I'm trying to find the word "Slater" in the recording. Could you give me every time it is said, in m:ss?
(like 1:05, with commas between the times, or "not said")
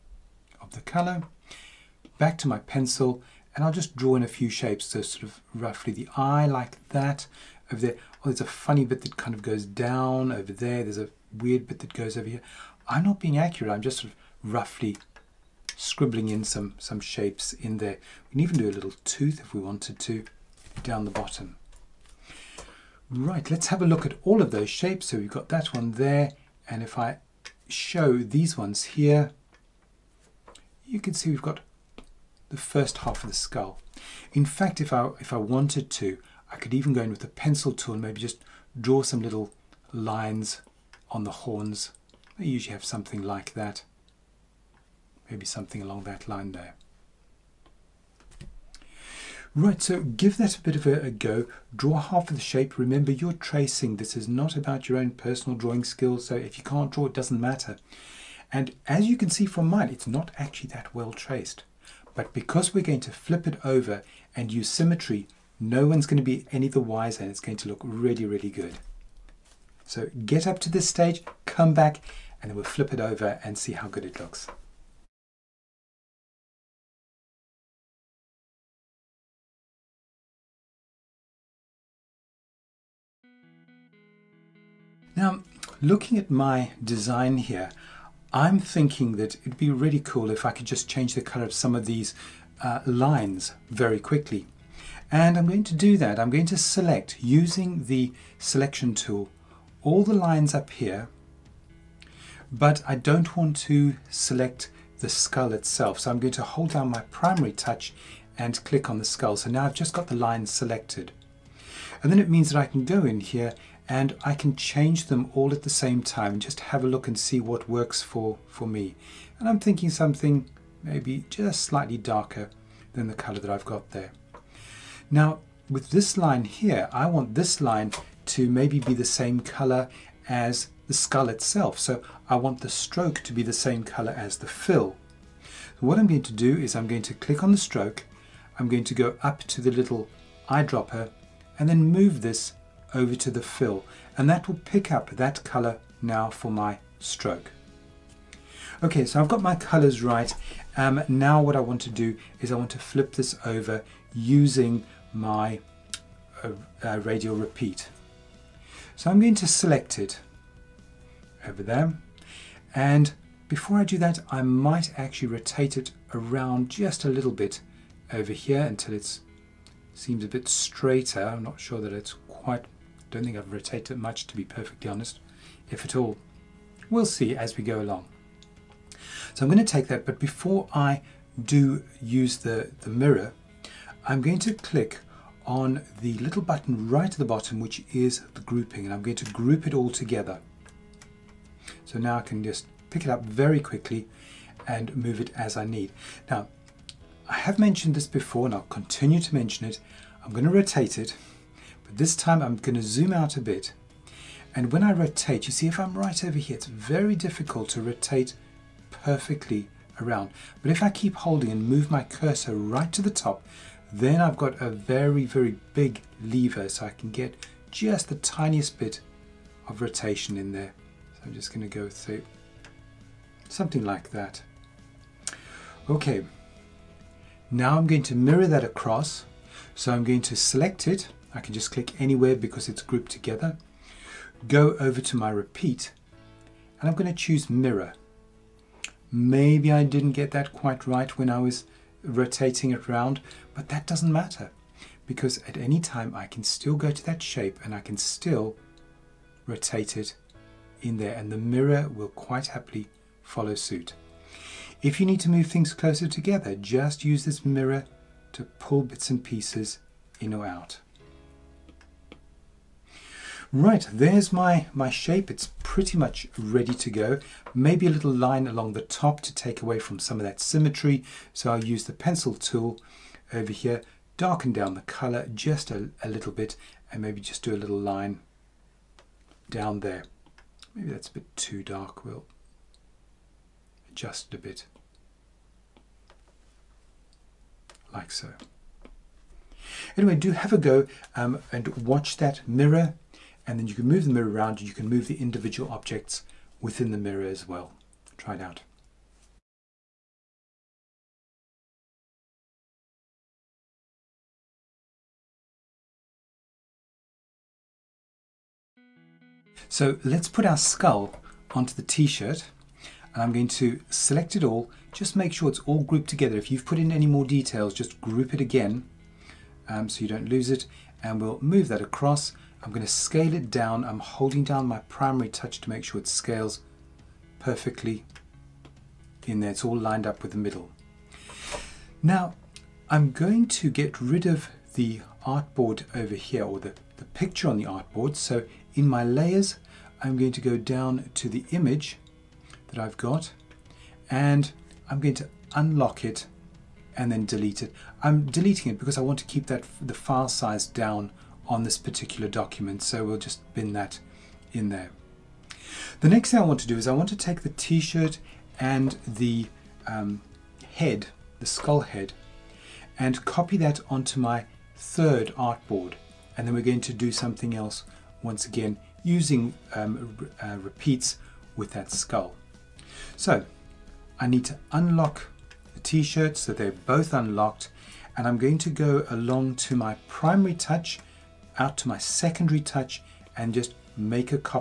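not said.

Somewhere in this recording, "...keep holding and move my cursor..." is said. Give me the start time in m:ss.
3:30.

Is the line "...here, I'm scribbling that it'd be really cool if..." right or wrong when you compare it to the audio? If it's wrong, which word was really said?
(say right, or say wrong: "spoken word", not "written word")
wrong: "thinking", not "scribbling".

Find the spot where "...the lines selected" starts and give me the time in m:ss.
1:50.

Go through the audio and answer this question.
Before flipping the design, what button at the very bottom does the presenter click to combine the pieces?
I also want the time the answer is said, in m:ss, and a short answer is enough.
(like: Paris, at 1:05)
Grouping, at 3:08.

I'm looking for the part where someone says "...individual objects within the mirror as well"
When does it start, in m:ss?
4:55.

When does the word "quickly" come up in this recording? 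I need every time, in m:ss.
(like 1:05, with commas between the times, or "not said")
1:33, 3:13.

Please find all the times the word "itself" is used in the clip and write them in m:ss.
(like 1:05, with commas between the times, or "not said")
1:45, 2:11.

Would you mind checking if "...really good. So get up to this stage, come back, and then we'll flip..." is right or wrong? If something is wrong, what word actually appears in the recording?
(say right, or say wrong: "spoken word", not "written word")
right.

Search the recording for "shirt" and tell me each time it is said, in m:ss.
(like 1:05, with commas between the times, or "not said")
5:11, 5:57, 6:15.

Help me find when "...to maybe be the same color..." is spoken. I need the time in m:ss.
2:08.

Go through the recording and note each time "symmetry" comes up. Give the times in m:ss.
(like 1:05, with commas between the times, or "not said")
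1:04, 4:30.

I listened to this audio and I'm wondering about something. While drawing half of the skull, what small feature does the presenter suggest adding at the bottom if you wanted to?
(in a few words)
A little tooth.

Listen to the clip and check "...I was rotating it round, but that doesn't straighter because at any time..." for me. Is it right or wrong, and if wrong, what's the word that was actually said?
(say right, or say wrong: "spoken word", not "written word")
wrong: "matter", not "straighter".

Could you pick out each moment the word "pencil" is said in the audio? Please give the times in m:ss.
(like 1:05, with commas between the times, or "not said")
0:02, 0:37, 4:31.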